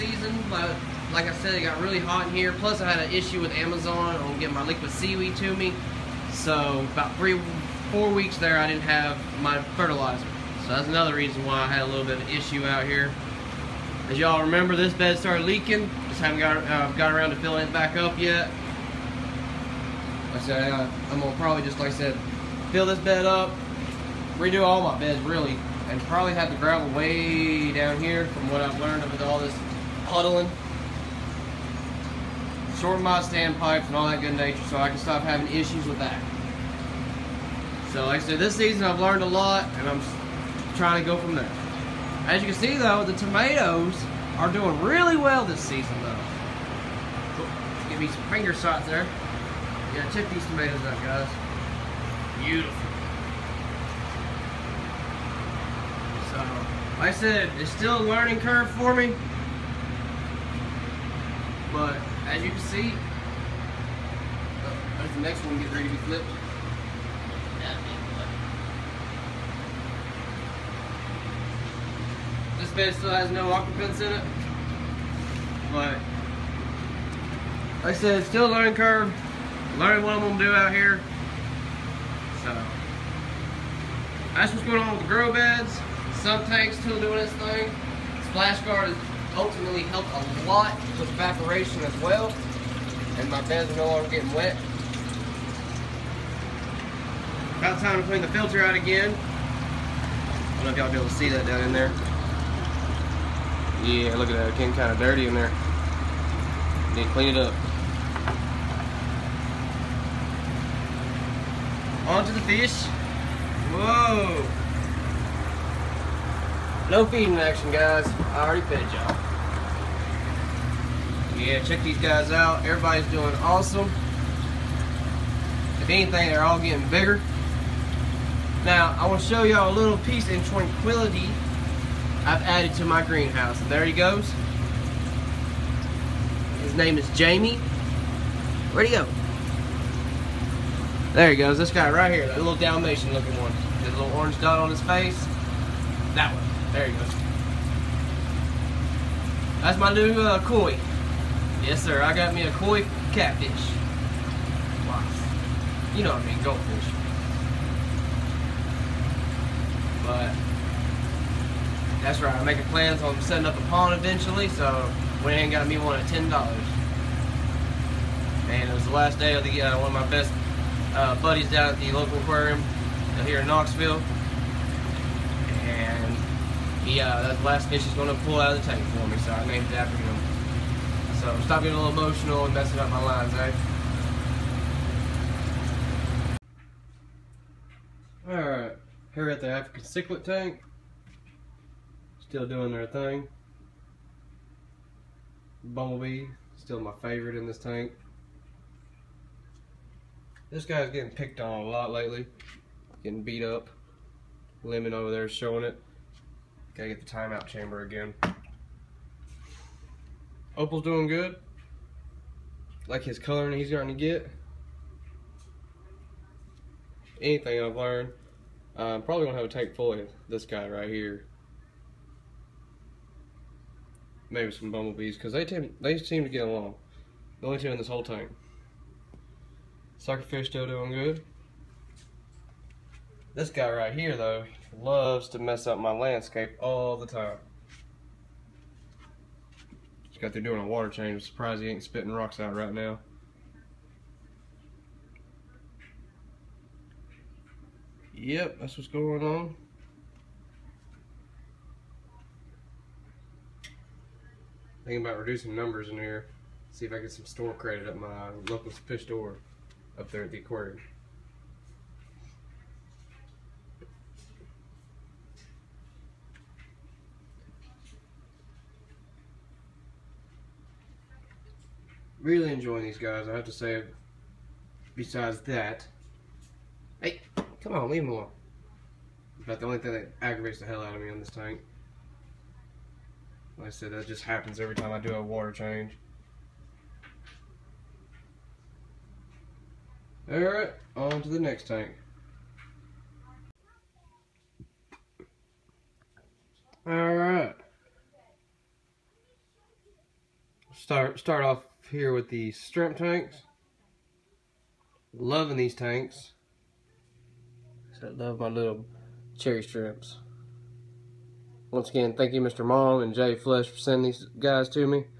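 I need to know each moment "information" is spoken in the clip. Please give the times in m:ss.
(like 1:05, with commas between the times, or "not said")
not said.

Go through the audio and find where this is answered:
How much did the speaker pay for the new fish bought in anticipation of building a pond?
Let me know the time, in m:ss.
2:46.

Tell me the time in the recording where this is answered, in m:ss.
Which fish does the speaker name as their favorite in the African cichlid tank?
3:15.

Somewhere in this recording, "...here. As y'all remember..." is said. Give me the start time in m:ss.
0:12.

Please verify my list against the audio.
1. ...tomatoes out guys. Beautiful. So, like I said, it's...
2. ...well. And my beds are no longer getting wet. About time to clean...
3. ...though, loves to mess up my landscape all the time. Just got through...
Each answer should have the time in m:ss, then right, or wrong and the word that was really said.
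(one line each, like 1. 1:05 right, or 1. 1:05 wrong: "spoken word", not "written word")
1. 0:50 right
2. 1:32 right
3. 3:54 right.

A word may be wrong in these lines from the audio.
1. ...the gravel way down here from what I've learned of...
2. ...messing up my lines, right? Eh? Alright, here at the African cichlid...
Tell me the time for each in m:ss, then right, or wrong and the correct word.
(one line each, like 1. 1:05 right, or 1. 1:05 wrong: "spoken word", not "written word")
1. 0:26 right
2. 3:02 right.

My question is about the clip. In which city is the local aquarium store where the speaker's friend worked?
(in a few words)
Knoxville.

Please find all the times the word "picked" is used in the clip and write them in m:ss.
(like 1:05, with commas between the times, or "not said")
3:21.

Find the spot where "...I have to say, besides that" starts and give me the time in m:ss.
4:33.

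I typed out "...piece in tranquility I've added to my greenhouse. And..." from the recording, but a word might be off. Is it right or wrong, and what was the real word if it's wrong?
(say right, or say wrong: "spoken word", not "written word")
right.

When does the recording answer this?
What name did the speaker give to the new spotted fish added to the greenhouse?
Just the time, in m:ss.
2:17.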